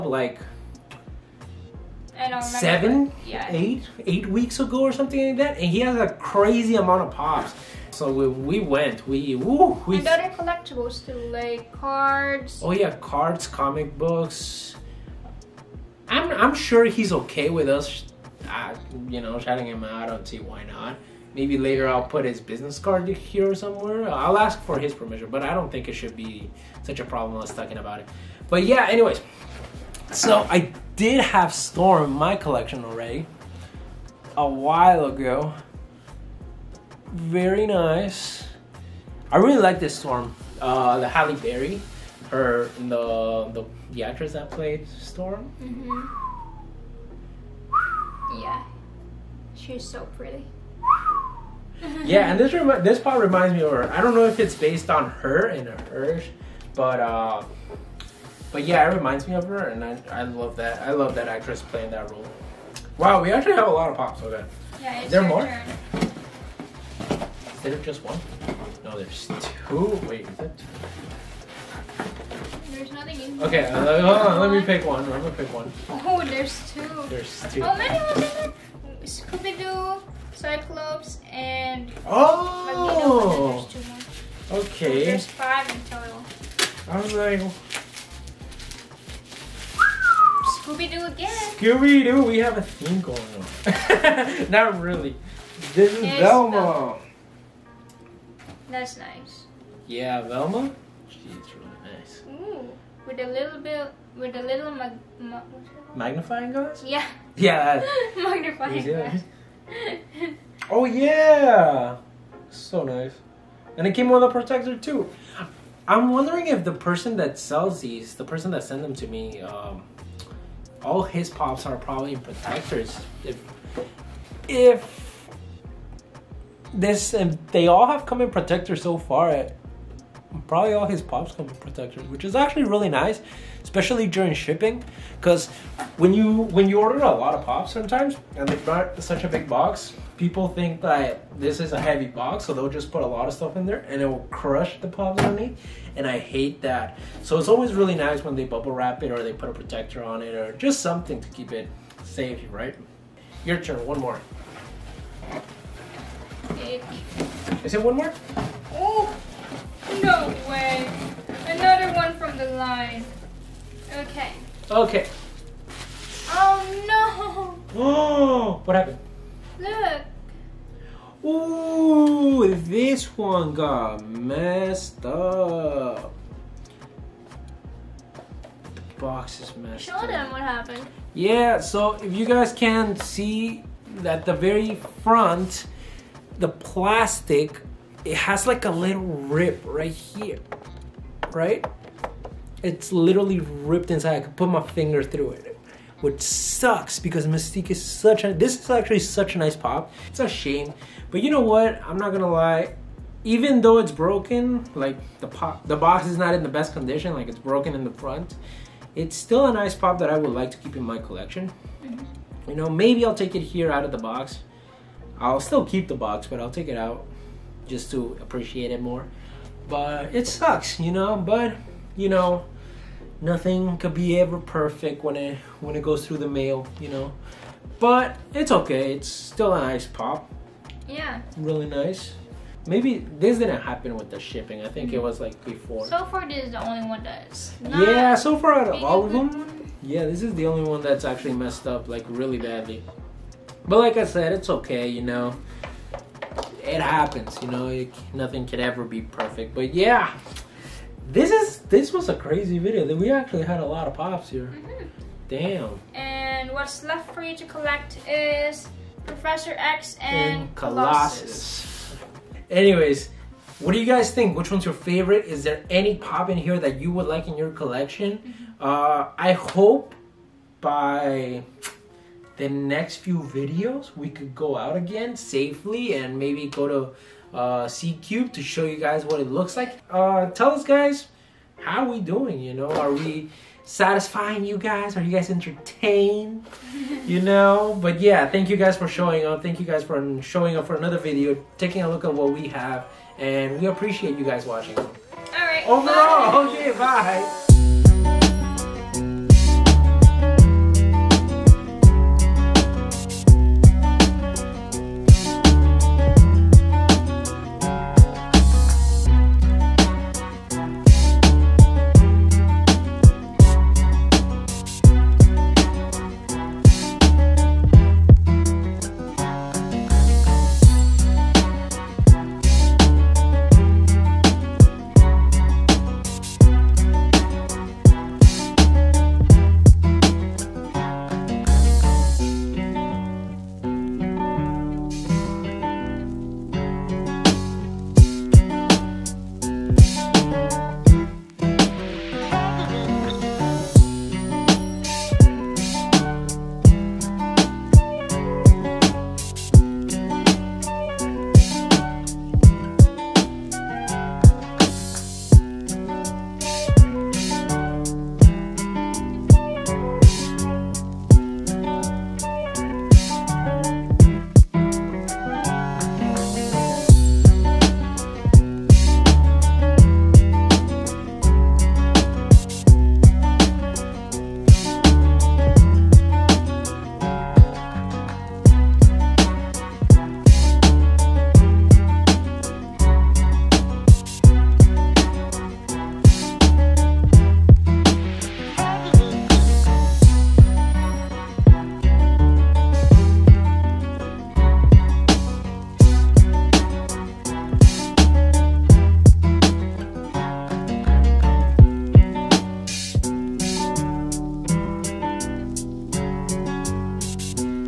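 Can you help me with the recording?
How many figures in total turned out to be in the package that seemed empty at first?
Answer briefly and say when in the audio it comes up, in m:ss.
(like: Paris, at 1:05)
5, at 1:25.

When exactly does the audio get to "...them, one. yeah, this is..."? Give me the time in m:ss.
3:59.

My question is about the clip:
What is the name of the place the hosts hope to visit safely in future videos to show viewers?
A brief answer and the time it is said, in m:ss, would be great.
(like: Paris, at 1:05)
C Cube, at 4:37.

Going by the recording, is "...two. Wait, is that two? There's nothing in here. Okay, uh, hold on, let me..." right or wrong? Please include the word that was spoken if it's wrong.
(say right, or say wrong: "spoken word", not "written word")
right.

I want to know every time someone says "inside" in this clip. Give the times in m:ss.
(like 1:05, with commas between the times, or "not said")
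3:13.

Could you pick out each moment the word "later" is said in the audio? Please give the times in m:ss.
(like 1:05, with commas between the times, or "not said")
0:21.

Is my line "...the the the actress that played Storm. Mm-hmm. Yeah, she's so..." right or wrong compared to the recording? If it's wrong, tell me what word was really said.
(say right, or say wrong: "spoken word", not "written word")
right.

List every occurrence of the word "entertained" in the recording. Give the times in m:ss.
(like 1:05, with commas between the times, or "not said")
4:45.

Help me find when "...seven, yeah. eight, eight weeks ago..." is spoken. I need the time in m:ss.
0:02.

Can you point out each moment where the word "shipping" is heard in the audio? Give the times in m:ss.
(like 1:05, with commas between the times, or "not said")
2:14, 3:54.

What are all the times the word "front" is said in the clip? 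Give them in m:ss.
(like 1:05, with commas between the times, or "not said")
3:05, 3:27.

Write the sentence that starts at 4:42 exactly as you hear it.
You know, are we satisfying you guys?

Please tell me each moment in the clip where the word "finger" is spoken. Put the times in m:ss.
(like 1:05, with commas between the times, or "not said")
3:14.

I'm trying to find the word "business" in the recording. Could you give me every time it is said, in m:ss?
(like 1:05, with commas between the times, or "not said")
0:22.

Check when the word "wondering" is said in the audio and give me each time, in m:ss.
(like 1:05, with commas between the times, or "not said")
1:56.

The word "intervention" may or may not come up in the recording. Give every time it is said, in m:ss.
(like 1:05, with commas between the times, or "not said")
not said.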